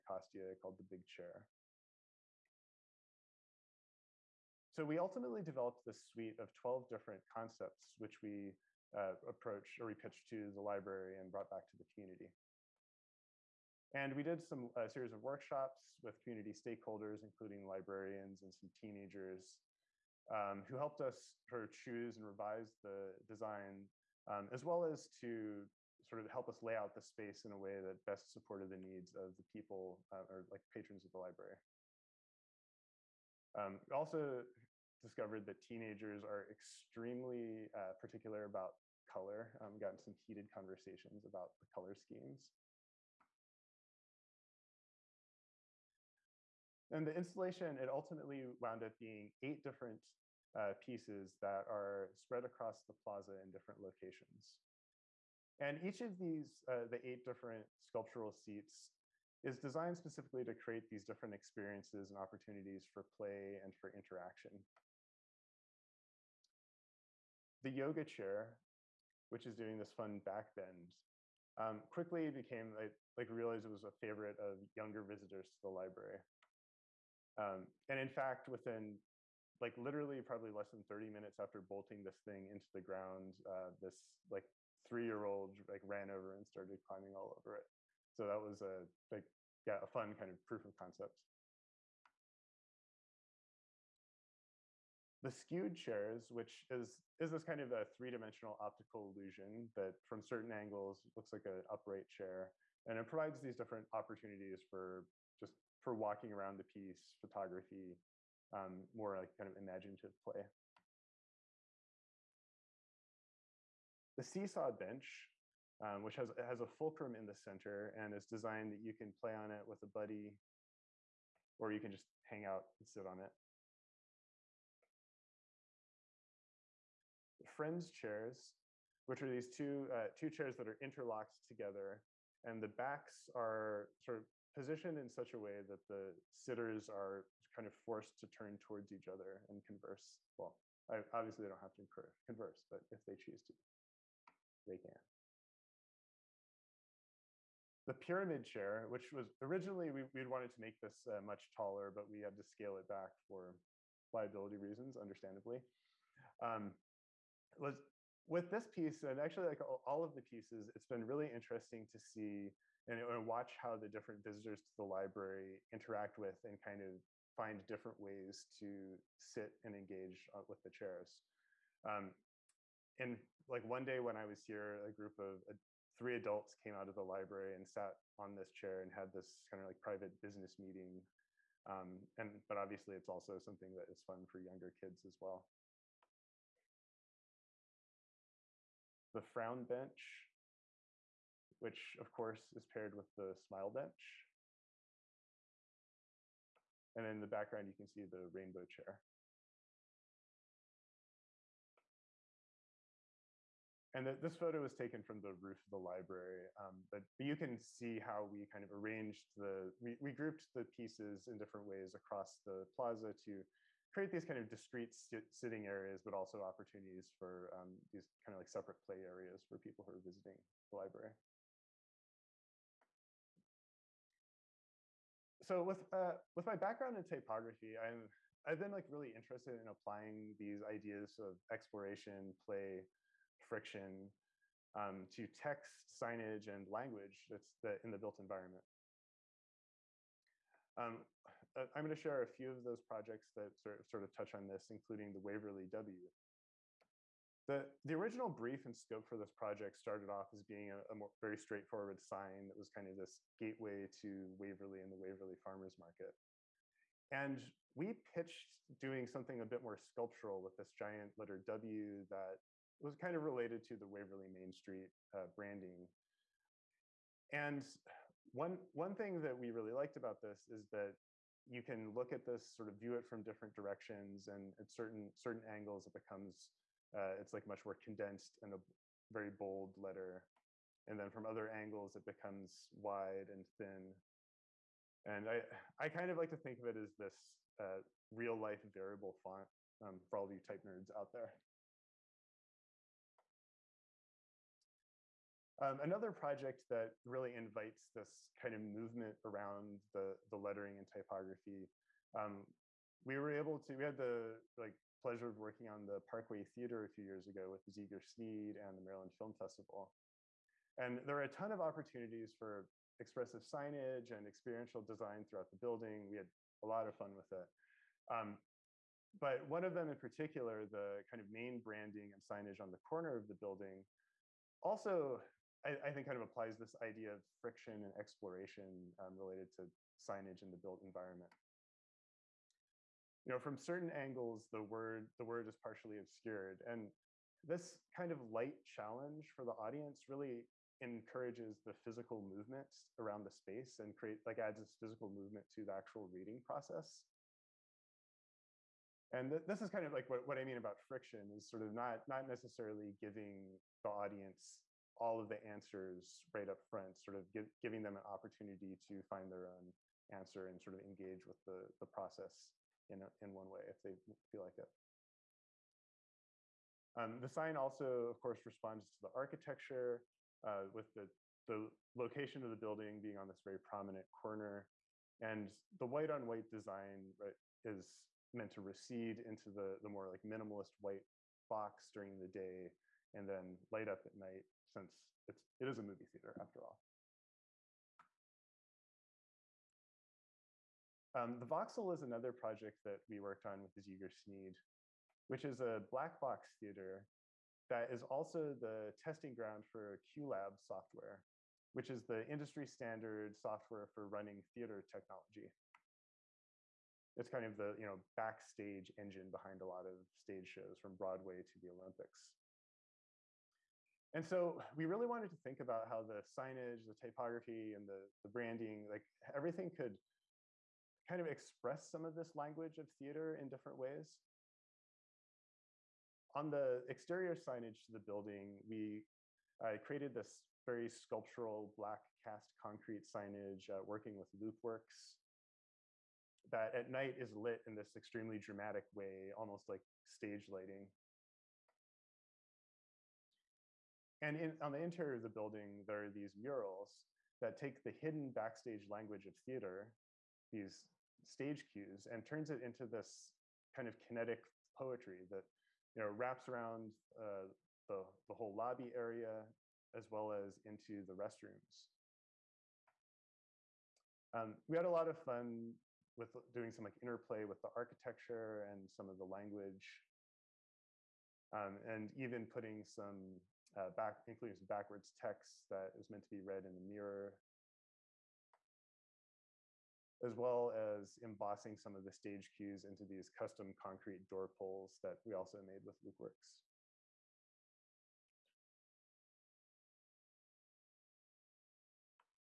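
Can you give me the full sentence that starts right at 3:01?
Um, and but obviously, it's also something that is fun for younger kids as well.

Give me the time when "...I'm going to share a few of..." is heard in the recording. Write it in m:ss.
4:01.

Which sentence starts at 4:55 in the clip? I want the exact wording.
Um, another project that really invites this kind of movement around the, the lettering and typography.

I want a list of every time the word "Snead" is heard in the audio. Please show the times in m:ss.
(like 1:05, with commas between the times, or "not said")
5:08, 6:34.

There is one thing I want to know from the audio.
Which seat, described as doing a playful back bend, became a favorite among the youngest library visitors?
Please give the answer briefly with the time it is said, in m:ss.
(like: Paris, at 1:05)
The yoga chair, at 1:07.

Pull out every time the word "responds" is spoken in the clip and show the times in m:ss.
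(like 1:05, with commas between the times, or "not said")
6:08.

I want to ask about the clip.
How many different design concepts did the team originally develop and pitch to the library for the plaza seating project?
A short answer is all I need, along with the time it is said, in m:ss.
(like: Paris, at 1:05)
12, at 0:06.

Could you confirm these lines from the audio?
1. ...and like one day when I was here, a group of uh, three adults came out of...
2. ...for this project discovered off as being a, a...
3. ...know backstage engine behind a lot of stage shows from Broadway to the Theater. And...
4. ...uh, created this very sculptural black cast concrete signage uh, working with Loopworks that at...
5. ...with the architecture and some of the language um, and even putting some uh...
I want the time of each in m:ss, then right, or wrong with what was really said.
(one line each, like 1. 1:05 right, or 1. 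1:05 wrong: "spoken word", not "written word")
1. 2:52 right
2. 4:09 wrong: "started", not "discovered"
3. 6:47 wrong: "Olympics", not "Theater"
4. 7:09 right
5. 7:47 right.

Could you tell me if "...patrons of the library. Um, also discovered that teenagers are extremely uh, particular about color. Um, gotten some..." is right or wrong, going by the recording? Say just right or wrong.
right.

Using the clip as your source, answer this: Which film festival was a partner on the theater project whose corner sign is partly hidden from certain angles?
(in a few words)
Maryland Film Festival.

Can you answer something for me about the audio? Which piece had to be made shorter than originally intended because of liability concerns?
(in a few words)
The pyramid chair.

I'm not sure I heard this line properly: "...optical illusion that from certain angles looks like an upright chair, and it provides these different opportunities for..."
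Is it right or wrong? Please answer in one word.
right.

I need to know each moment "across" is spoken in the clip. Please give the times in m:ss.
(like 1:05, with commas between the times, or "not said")
0:52, 3:31.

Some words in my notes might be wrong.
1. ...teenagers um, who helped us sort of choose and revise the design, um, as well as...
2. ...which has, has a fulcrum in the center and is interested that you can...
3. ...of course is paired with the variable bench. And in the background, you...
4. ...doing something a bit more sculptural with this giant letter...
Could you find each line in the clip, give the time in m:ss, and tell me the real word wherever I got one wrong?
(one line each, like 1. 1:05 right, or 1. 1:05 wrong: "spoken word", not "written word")
1. 0:18 right
2. 1:56 wrong: "designed", not "interested"
3. 3:11 wrong: "smile", not "variable"
4. 4:18 right.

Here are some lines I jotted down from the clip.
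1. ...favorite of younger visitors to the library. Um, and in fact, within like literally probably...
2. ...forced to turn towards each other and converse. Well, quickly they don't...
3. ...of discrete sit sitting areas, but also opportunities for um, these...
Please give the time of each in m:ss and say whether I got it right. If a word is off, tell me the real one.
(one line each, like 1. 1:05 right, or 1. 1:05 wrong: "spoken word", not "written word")
1. 1:14 right
2. 2:17 wrong: "obviously", not "quickly"
3. 3:34 right.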